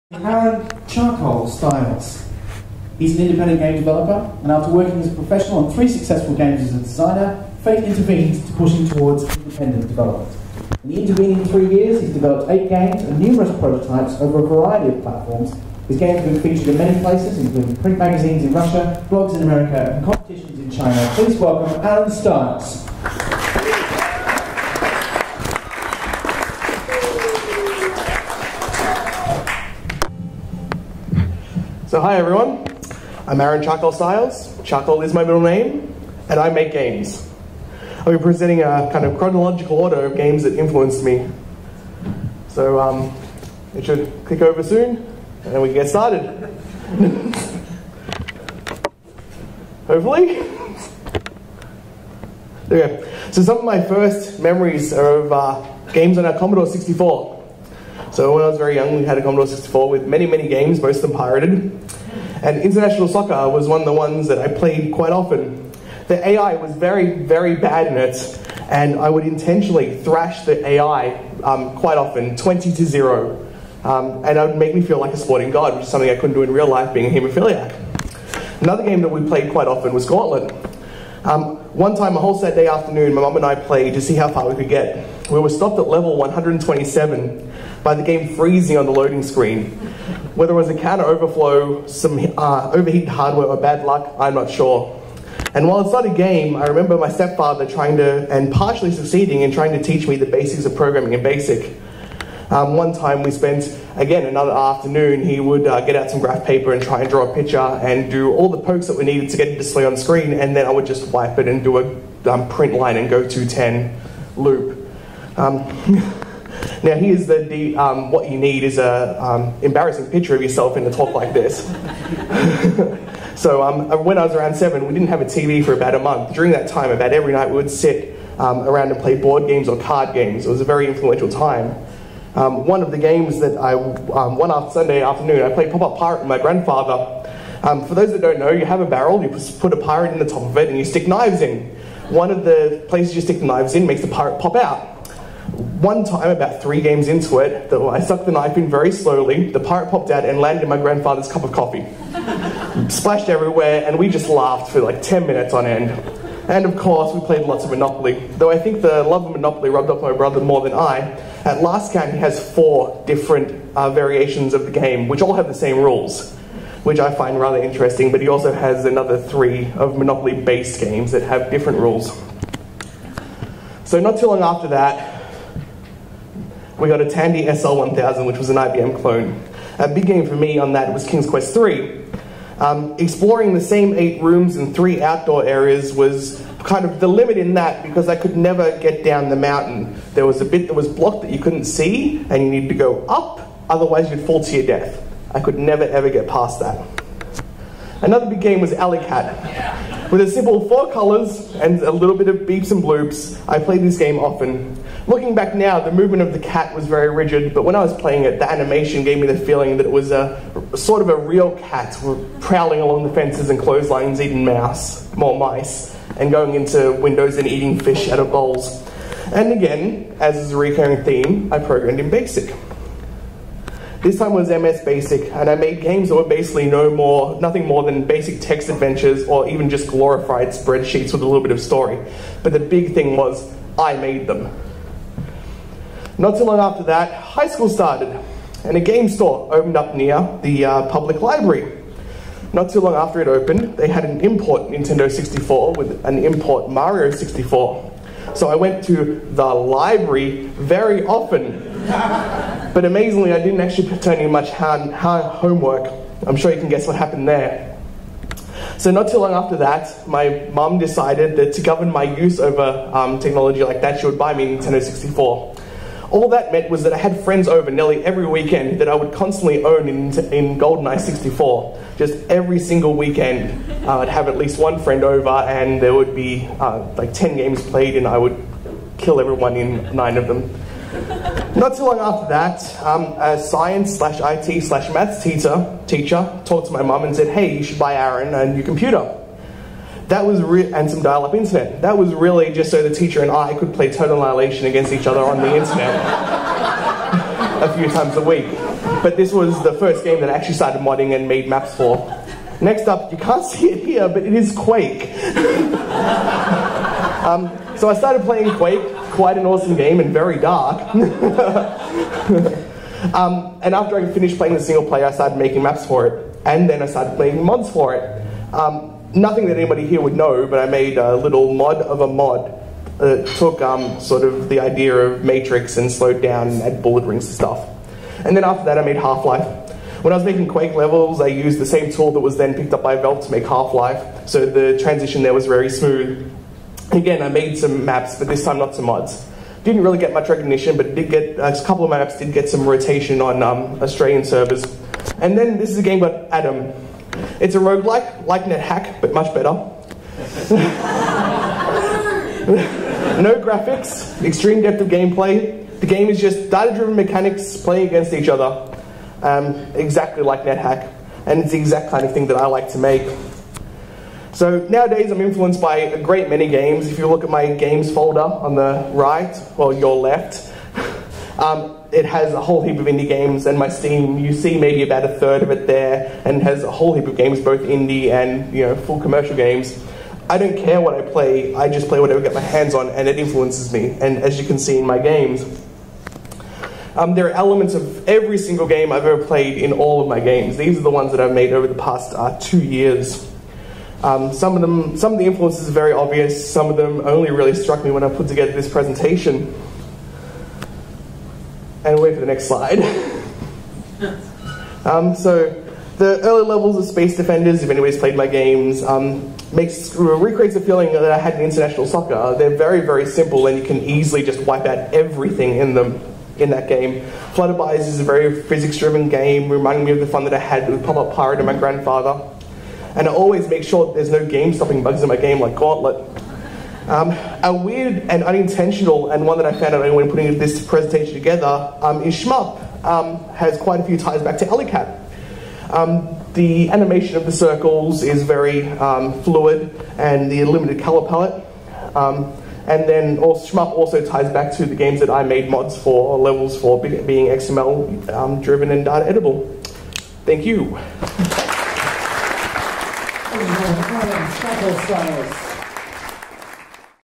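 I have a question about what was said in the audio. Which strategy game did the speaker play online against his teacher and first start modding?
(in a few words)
Total Annihilation.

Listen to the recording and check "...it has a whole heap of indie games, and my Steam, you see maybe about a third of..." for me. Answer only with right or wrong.
right.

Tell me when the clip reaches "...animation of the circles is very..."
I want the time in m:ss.
7:16.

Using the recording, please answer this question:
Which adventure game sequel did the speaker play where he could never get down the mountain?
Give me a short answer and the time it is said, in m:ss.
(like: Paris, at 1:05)
King's Quest 3, at 3:01.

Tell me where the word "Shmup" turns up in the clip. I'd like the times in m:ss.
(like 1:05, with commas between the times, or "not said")
7:12, 7:23.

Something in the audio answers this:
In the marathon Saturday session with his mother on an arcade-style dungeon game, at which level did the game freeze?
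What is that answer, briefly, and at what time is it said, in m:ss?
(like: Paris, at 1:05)
127, at 1:25.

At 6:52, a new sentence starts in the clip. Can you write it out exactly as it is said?
They're very, very simple and you can easily just wipe out everything in them in that game.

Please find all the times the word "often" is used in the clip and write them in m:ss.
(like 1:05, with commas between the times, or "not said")
1:05, 1:11, 1:19, 3:24, 4:11.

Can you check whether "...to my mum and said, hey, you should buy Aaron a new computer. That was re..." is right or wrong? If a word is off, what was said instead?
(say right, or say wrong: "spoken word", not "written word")
right.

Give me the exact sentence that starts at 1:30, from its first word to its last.
Whether it was a counter overflow, some uh, overheated hardware, or bad luck, I'm not sure.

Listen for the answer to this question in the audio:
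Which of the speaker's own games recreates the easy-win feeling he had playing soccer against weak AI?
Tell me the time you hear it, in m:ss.
6:46.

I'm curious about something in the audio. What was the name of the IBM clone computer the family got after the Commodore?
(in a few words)
Tandy SL1000.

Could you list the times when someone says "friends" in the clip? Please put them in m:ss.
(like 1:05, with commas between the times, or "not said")
4:27, 4:34.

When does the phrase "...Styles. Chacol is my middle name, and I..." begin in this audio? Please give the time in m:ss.
0:33.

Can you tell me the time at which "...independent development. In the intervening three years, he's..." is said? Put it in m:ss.
0:09.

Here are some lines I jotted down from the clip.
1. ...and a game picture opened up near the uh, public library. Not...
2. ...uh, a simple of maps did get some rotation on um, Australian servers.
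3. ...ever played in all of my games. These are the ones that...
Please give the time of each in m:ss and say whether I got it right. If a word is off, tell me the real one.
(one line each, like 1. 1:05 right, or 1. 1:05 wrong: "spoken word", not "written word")
1. 3:58 wrong: "store", not "picture"
2. 5:41 wrong: "couple", not "simple"
3. 6:29 right.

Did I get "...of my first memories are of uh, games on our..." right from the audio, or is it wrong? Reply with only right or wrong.
right.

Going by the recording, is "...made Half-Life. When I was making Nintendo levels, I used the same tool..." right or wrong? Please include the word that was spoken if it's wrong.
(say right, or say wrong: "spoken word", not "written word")
wrong: "Quake", not "Nintendo".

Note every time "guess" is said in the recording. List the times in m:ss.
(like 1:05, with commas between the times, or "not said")
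4:16.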